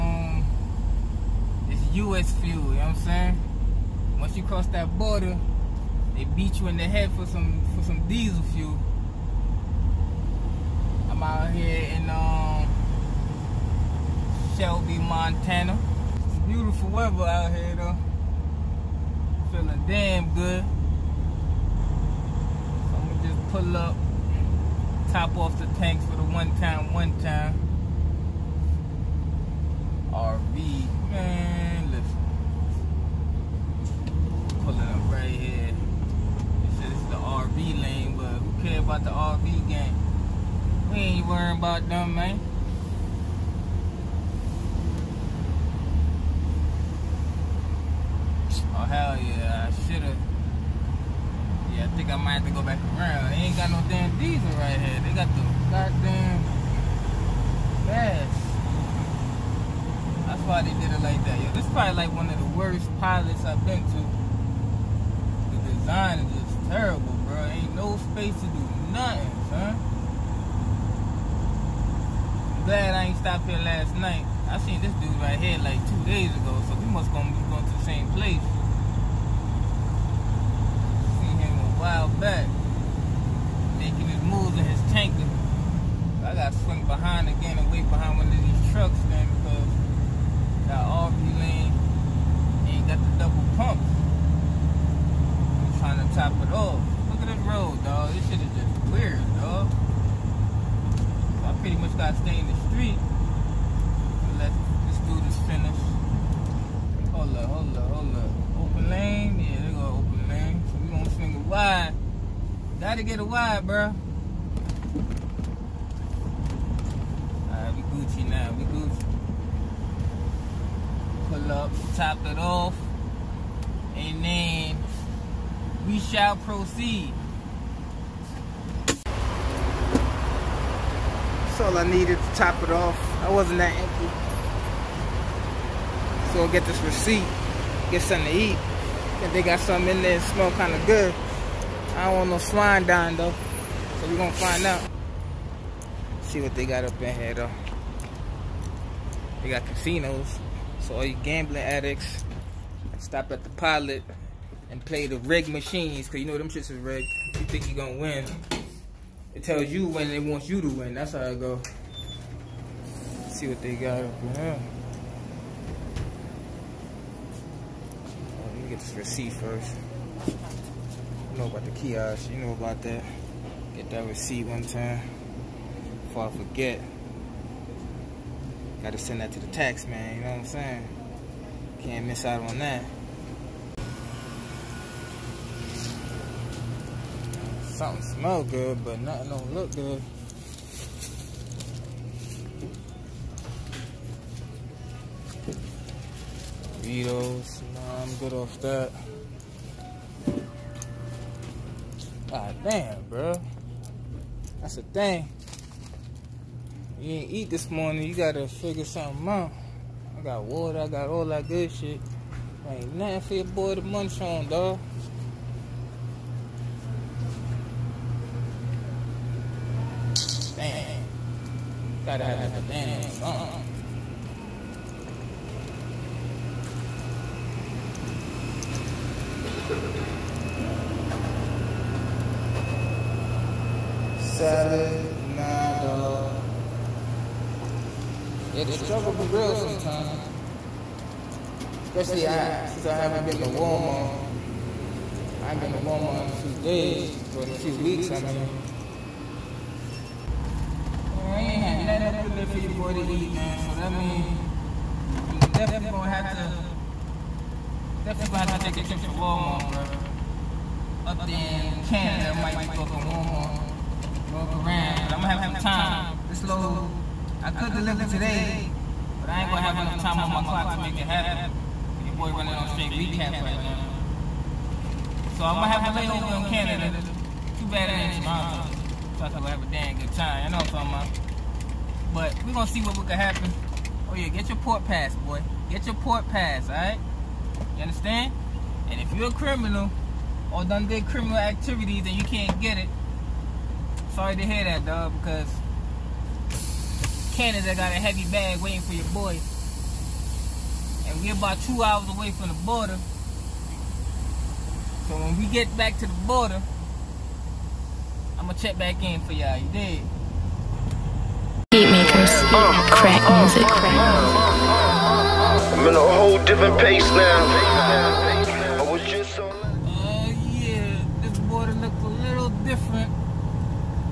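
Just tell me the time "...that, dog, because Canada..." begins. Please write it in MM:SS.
04:54.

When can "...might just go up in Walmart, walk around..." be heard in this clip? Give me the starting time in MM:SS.
04:22.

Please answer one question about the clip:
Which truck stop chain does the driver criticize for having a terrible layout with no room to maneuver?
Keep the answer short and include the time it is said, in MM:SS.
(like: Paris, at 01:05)
Pilot, at 01:02.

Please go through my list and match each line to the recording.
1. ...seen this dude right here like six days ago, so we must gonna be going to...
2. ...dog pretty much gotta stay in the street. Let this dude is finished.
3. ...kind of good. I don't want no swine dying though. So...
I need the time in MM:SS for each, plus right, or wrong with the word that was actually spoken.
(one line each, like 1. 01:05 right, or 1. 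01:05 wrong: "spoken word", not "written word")
1. 01:14 wrong: "two", not "six"
2. 01:39 right
3. 02:20 right.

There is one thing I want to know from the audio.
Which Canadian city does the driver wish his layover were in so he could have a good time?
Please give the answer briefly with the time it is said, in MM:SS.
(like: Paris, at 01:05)
Toronto, at 04:38.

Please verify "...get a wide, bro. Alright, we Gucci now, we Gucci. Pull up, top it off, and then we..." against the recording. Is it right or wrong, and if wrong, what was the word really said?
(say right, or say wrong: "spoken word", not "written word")
right.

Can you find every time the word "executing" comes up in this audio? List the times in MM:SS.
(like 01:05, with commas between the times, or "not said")
not said.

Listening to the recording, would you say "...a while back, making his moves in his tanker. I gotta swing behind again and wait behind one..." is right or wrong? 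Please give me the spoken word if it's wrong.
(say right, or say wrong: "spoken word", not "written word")
right.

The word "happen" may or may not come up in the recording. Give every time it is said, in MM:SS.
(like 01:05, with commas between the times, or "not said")
04:31, 04:43.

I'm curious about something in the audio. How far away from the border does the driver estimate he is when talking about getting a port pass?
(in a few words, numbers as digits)
2 hours.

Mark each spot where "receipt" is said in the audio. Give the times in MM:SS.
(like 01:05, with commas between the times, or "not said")
02:16, 02:48, 02:54.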